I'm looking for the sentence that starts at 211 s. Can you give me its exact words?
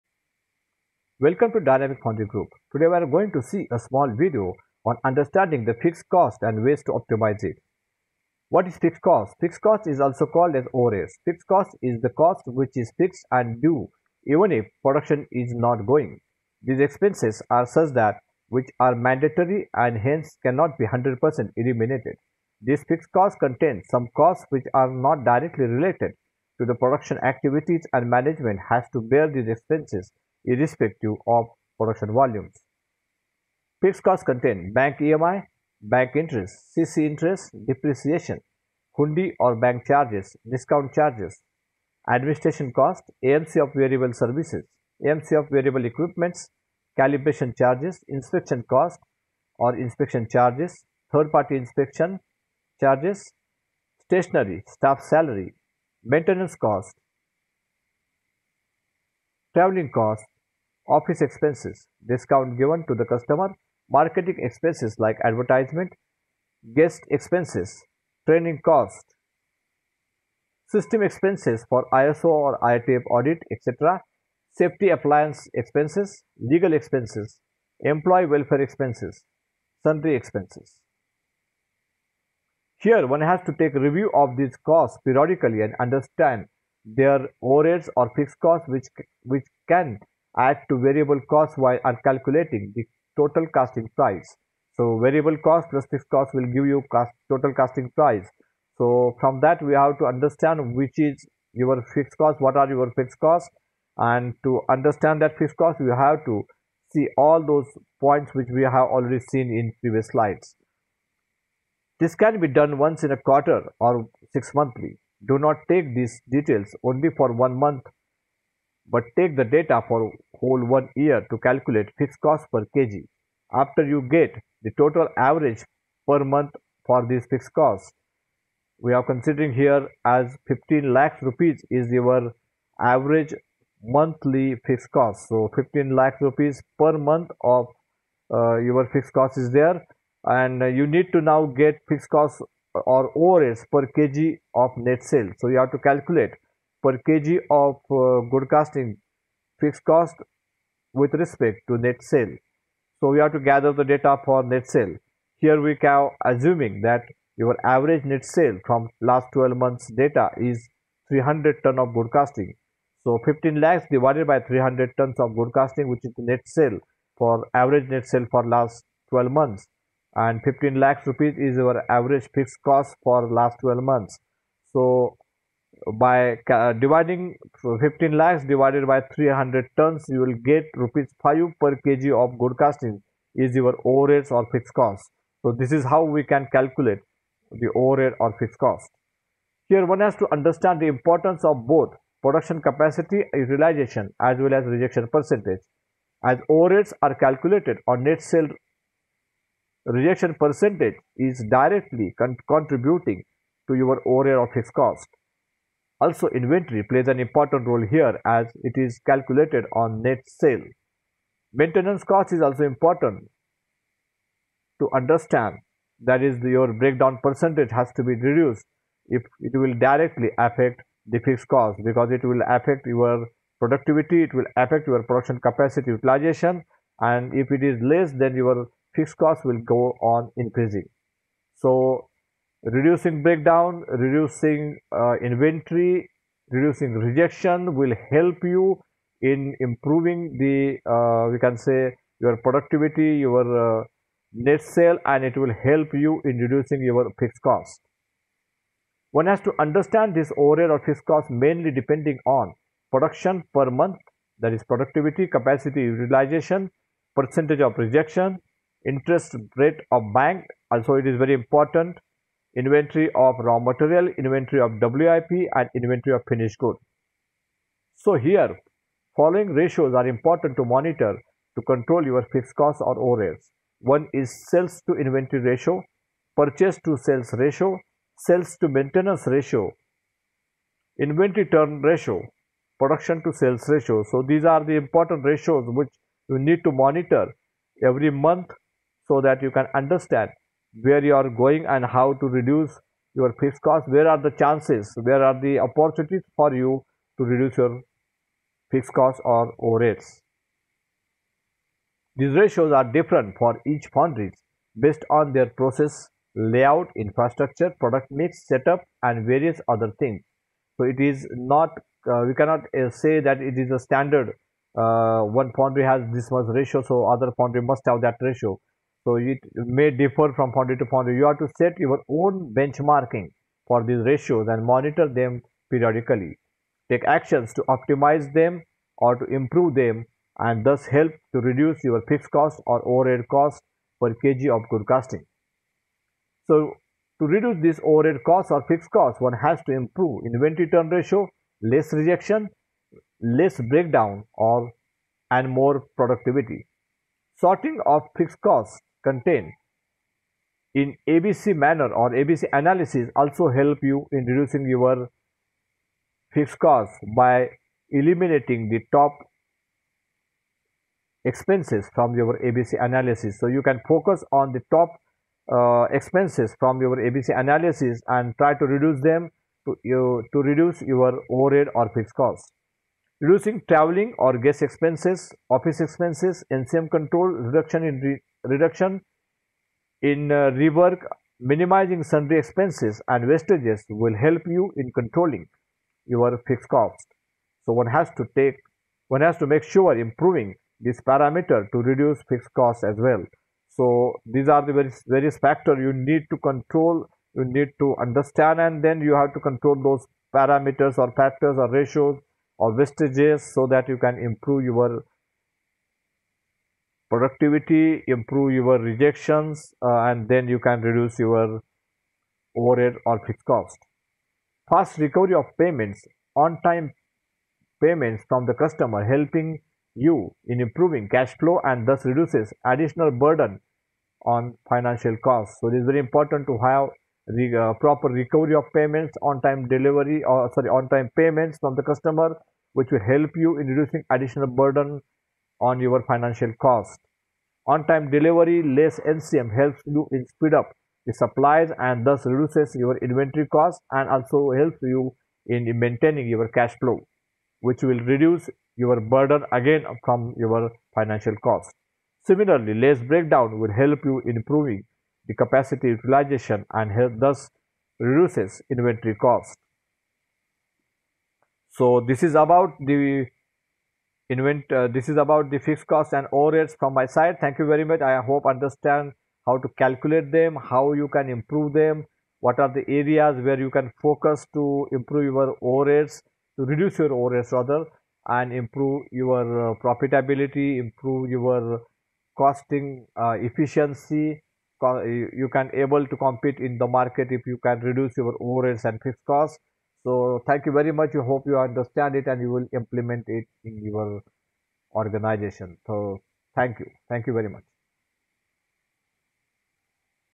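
Maintenance cost is also important to understand.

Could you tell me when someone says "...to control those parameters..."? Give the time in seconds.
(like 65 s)
399 s.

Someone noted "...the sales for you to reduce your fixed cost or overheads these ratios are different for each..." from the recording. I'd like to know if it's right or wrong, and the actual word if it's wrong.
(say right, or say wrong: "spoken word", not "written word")
wrong: "opportunities", not "sales".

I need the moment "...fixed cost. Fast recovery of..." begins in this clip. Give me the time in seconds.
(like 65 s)
413 s.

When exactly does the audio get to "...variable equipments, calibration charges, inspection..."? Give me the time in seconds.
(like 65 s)
45 s.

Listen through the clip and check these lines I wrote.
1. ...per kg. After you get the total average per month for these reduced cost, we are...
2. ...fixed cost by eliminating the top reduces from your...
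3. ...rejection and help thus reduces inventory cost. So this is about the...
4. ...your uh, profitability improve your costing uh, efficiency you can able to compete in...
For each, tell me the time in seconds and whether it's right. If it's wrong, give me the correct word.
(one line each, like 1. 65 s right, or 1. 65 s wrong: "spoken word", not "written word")
1. 122 s wrong: "fixed", not "reduced"
2. 356 s wrong: "expenses", not "reduces"
3. 455 s wrong: "utilization", not "rejection"
4. 479 s right.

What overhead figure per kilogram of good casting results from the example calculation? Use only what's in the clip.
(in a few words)
Rs 5 per kg.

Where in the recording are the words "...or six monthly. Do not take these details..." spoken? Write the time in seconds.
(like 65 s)
113 s.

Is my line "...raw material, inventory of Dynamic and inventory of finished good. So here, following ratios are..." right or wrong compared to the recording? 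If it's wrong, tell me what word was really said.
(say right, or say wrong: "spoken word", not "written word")
wrong: "WIP", not "Dynamic".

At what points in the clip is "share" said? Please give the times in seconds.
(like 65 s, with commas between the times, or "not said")
not said.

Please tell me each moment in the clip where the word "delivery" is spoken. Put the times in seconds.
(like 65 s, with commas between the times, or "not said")
429 s, 438 s.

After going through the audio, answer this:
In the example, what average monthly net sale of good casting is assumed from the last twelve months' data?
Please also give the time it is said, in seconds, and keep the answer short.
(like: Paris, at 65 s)
300 tons, at 161 s.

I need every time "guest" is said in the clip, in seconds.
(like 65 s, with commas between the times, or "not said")
66 s, 374 s.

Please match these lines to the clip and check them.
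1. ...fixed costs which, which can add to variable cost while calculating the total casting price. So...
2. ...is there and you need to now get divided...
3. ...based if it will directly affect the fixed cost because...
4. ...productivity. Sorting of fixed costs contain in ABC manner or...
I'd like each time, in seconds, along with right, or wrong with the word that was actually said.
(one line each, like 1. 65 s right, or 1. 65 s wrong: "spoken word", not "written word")
1. 88 s right
2. 139 s wrong: "fixed", not "divided"
3. 218 s wrong: "reduced", not "based"
4. 345 s right.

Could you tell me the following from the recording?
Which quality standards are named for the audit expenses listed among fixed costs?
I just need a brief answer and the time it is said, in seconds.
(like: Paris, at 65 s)
ISO or IATF, at 71 s.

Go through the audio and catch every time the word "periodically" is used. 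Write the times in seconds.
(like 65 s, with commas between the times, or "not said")
85 s, 325 s.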